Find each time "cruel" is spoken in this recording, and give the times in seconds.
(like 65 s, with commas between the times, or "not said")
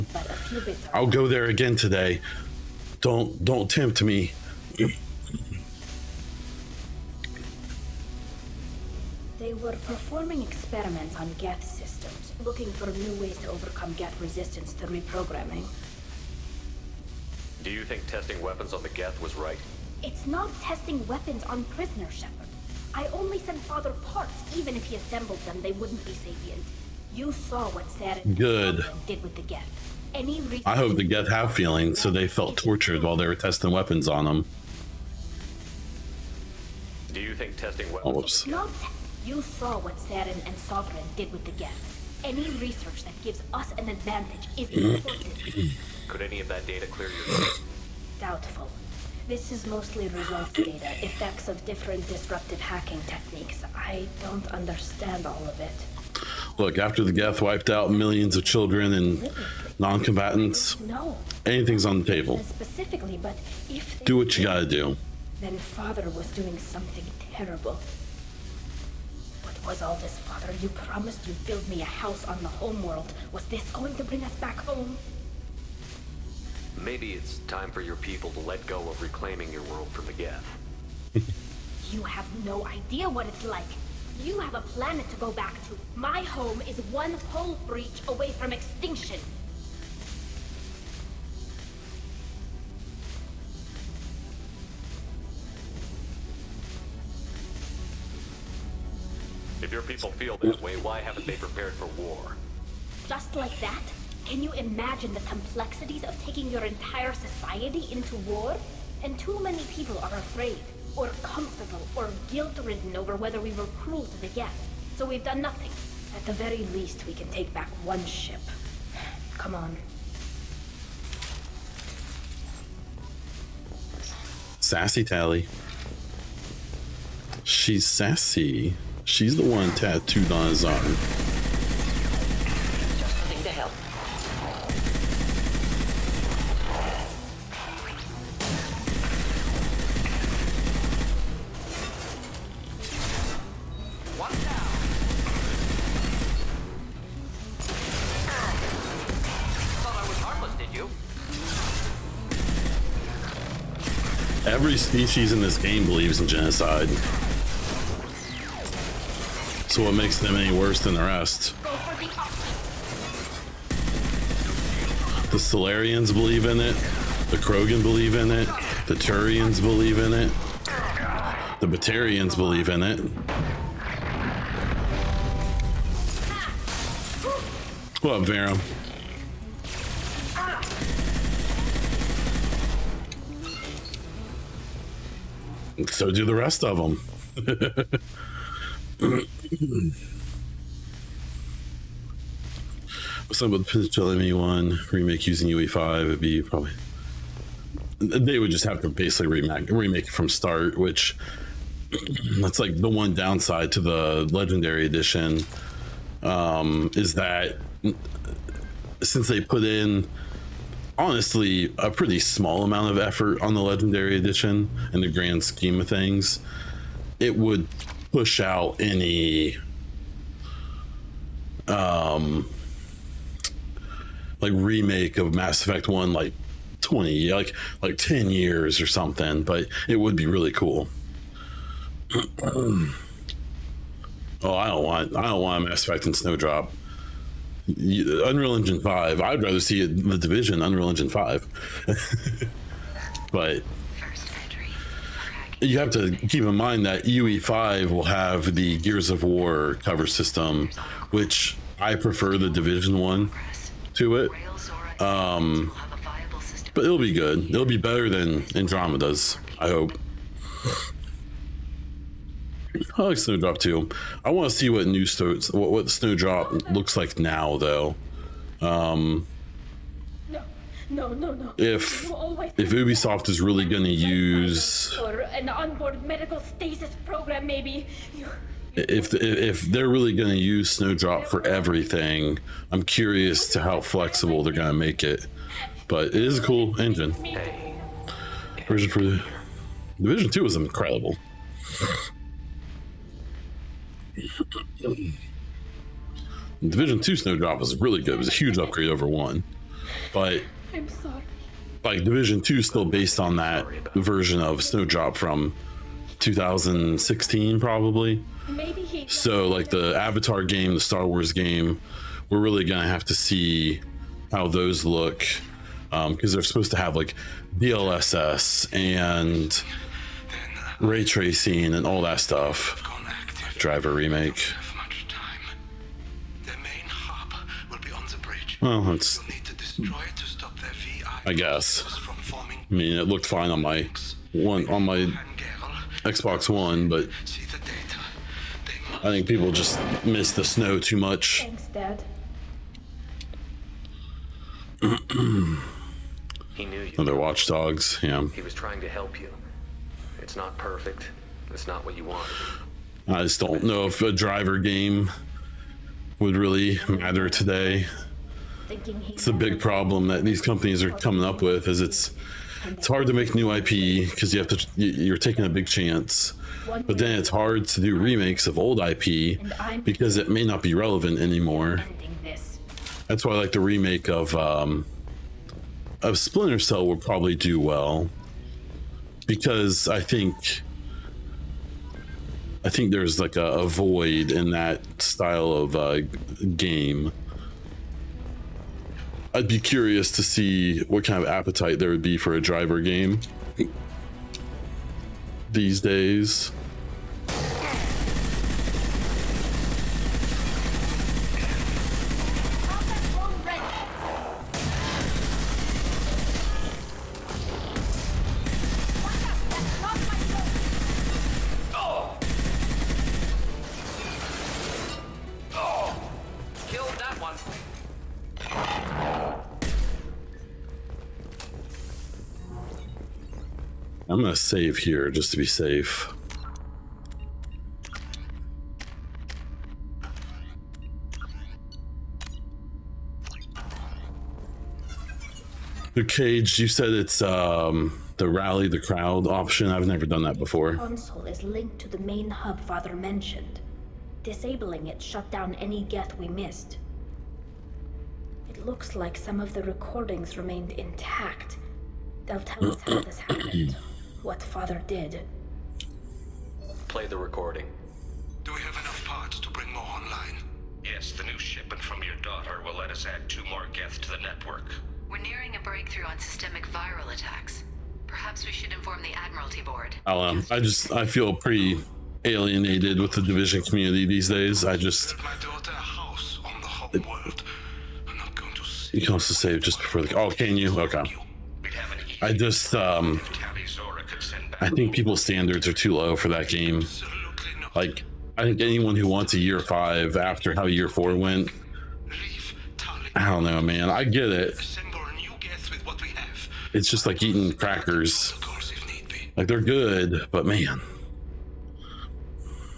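113 s.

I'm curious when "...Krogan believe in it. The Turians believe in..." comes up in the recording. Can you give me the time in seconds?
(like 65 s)
167 s.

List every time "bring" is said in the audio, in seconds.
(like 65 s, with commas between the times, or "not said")
74 s, 459 s.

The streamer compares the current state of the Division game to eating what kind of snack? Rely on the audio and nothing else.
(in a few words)
Crackers.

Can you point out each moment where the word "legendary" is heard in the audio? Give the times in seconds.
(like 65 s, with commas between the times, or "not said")
204 s, 213 s.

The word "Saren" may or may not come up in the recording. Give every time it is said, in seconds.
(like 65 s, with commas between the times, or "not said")
27 s, 39 s.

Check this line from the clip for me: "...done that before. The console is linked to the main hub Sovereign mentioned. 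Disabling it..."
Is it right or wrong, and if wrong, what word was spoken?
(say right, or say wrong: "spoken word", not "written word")
wrong: "Father", not "Sovereign".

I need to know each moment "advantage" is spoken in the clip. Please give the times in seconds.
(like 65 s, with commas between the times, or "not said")
43 s.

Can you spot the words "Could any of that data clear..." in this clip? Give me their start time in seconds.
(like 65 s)
46 s.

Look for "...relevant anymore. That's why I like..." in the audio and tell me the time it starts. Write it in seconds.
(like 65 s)
370 s.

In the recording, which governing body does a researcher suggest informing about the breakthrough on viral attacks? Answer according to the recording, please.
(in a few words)
Admiralty Board.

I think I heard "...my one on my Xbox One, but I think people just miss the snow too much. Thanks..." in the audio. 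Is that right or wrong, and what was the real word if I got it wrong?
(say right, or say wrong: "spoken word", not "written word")
right.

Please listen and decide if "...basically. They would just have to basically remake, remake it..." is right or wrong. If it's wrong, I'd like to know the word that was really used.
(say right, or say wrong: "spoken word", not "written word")
wrong: "probably", not "basically".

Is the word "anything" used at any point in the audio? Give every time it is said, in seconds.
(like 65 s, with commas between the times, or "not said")
61 s.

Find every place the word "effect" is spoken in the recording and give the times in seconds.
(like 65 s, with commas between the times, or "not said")
51 s, 225 s, 235 s.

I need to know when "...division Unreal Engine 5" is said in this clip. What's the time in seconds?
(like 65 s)
240 s.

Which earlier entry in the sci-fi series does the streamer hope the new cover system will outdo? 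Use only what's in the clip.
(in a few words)
Andromeda.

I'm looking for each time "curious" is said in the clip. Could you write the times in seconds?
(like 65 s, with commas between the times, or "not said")
282 s, 389 s.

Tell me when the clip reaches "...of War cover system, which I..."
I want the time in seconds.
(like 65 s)
249 s.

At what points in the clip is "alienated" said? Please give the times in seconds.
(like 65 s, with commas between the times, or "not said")
472 s.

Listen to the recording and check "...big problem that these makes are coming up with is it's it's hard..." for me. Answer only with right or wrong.
wrong.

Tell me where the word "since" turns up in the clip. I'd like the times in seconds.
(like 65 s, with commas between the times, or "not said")
209 s.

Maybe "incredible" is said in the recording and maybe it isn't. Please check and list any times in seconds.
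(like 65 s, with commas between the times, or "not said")
290 s.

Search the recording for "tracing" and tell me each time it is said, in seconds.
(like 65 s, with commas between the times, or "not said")
321 s.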